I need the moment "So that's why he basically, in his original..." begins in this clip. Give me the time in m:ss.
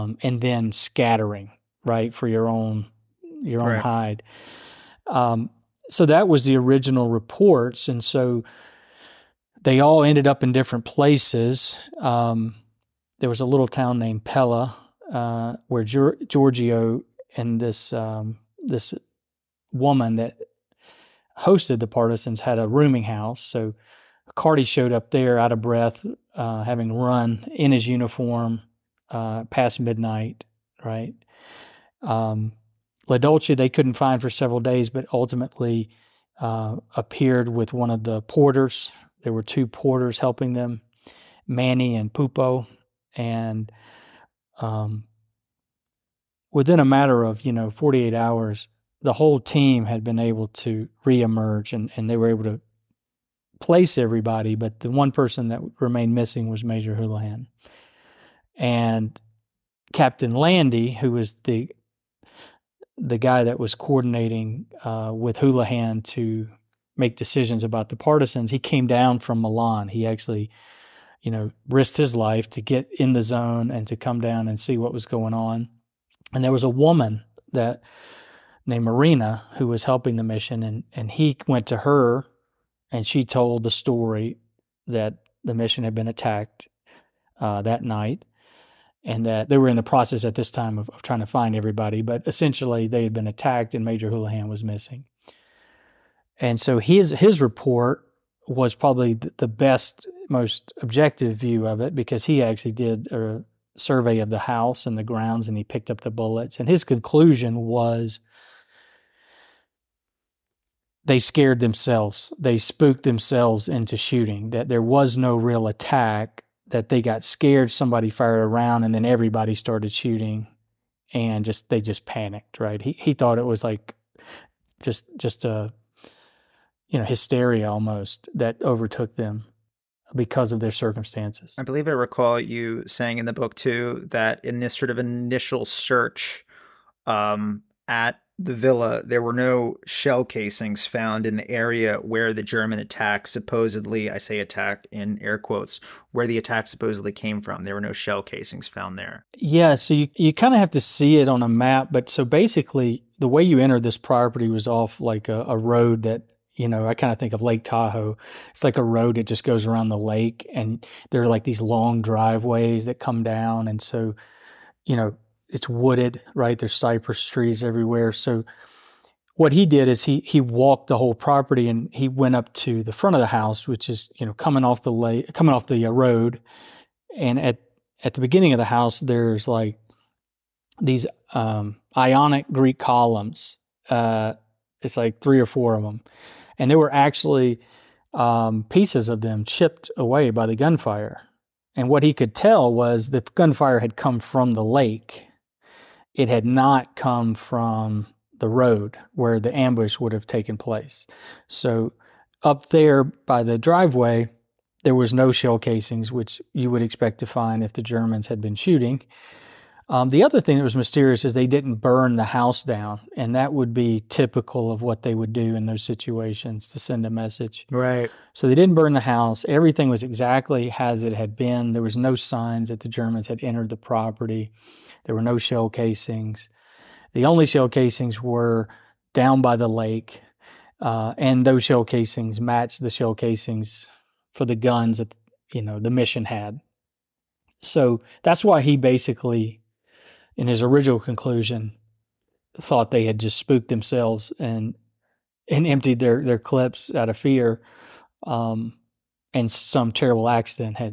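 3:57.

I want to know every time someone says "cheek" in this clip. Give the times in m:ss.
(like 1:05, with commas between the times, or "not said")
not said.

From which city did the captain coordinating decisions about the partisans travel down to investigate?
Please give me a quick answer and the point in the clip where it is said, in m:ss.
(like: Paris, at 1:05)
Milan, at 1:09.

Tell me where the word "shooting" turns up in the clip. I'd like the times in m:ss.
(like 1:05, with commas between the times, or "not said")
1:53, 1:59, 3:28.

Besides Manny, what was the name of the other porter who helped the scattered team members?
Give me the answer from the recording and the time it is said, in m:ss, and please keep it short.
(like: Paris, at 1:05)
Pupo, at 0:42.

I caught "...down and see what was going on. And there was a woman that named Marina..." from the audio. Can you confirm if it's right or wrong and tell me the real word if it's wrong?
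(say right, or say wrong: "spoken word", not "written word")
right.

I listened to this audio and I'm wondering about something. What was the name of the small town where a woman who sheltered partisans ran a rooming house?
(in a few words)
Pella.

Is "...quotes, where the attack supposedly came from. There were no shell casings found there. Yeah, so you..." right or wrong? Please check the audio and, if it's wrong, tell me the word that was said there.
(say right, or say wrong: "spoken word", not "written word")
right.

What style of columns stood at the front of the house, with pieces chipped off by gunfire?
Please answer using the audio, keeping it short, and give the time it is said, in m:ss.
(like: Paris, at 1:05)
Ionic Greek columns, at 3:01.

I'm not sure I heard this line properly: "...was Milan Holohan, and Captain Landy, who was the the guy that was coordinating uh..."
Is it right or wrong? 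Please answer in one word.
wrong.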